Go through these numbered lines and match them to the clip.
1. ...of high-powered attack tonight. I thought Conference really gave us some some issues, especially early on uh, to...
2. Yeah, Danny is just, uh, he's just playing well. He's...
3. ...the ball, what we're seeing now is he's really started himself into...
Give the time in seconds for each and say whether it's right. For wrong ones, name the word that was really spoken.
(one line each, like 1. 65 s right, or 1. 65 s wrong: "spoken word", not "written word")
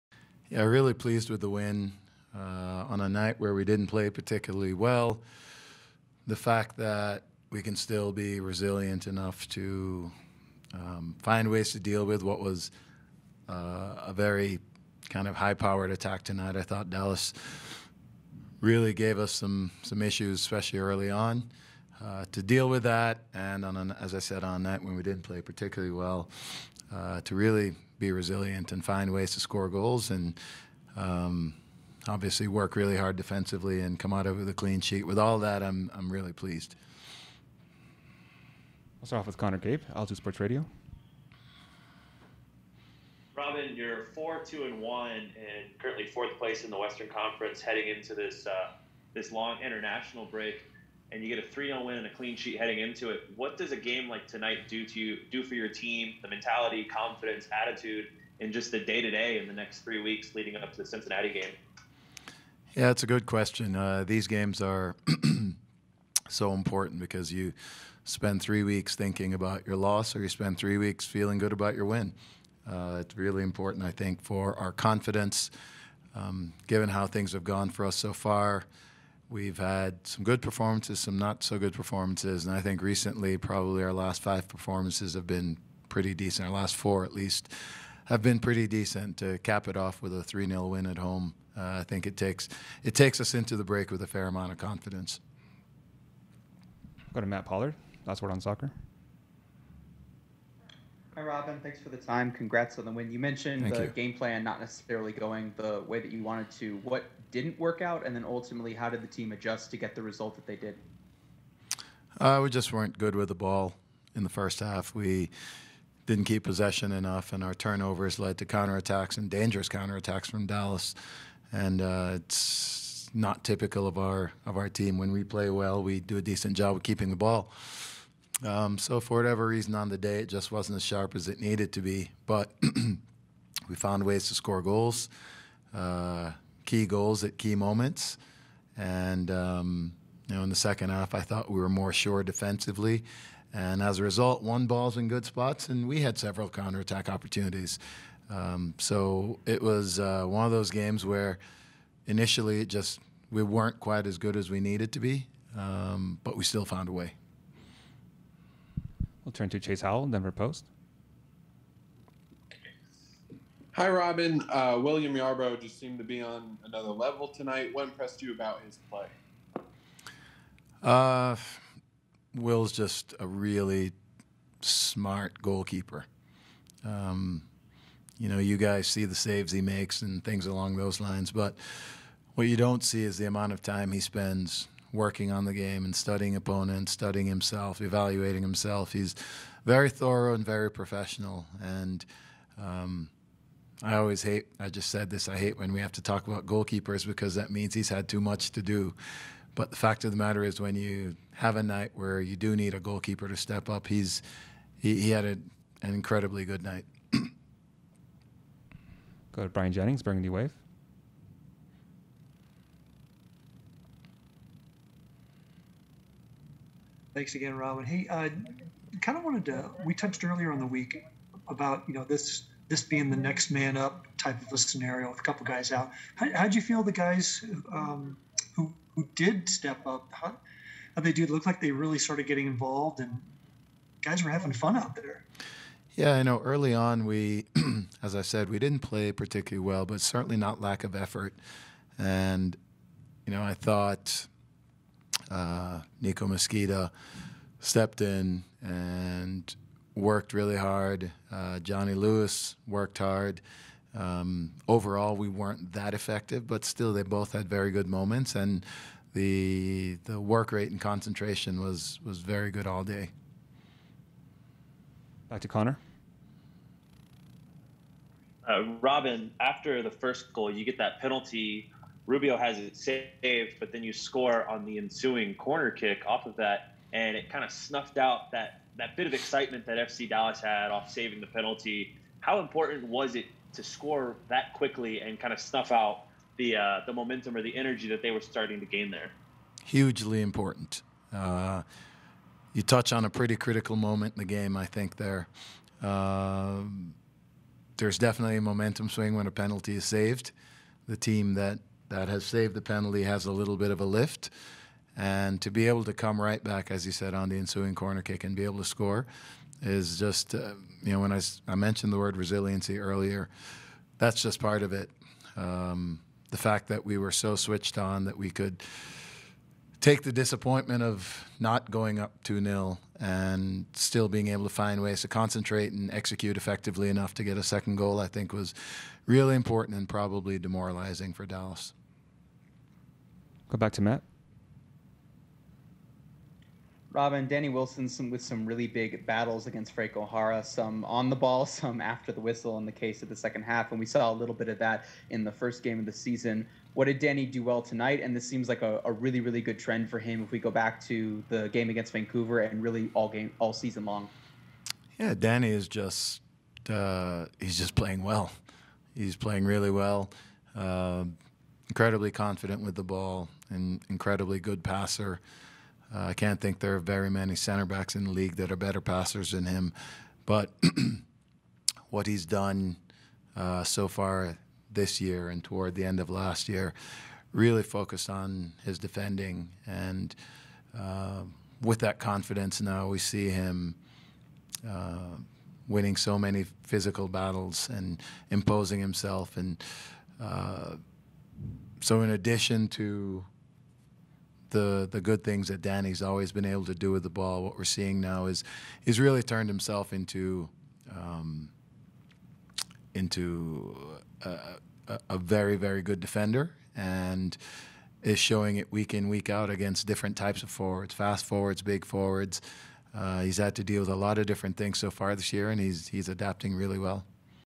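1. 15 s wrong: "Dallas", not "Conference"
2. 354 s right
3. 397 s wrong: "turned", not "started".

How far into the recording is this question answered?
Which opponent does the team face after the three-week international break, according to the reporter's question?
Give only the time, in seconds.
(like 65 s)
60 s.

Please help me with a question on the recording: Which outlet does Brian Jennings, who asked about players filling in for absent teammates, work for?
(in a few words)
Burgundy Wave.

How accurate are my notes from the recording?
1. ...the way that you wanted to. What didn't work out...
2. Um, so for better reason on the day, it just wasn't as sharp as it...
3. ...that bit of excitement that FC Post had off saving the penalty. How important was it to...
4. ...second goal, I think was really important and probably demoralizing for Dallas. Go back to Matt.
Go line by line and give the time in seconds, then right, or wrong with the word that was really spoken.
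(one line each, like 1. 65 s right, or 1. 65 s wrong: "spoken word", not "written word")
1. 105 s right
2. 128 s wrong: "whatever", not "better"
3. 278 s wrong: "Dallas", not "Post"
4. 327 s right.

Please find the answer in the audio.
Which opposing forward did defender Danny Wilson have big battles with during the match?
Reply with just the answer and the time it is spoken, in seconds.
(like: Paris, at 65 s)
Franco Jara, at 339 s.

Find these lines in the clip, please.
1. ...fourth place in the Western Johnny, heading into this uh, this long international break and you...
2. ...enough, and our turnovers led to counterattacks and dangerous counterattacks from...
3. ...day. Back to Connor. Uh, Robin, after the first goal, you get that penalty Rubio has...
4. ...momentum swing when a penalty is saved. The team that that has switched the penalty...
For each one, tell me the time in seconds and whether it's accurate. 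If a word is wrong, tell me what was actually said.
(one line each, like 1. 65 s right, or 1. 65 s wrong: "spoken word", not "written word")
1. 46 s wrong: "Conference", not "Johnny"
2. 116 s right
3. 262 s right
4. 298 s wrong: "saved", not "switched".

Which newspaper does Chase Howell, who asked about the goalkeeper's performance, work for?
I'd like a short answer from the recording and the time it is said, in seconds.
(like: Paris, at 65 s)
Denver Post, at 160 s.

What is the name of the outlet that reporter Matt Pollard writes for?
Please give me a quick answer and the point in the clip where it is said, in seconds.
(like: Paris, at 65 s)
Last Word on Soccer, at 98 s.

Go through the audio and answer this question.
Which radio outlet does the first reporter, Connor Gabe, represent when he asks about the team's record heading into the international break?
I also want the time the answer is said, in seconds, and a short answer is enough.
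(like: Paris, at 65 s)
Altitude Sports Radio, at 39 s.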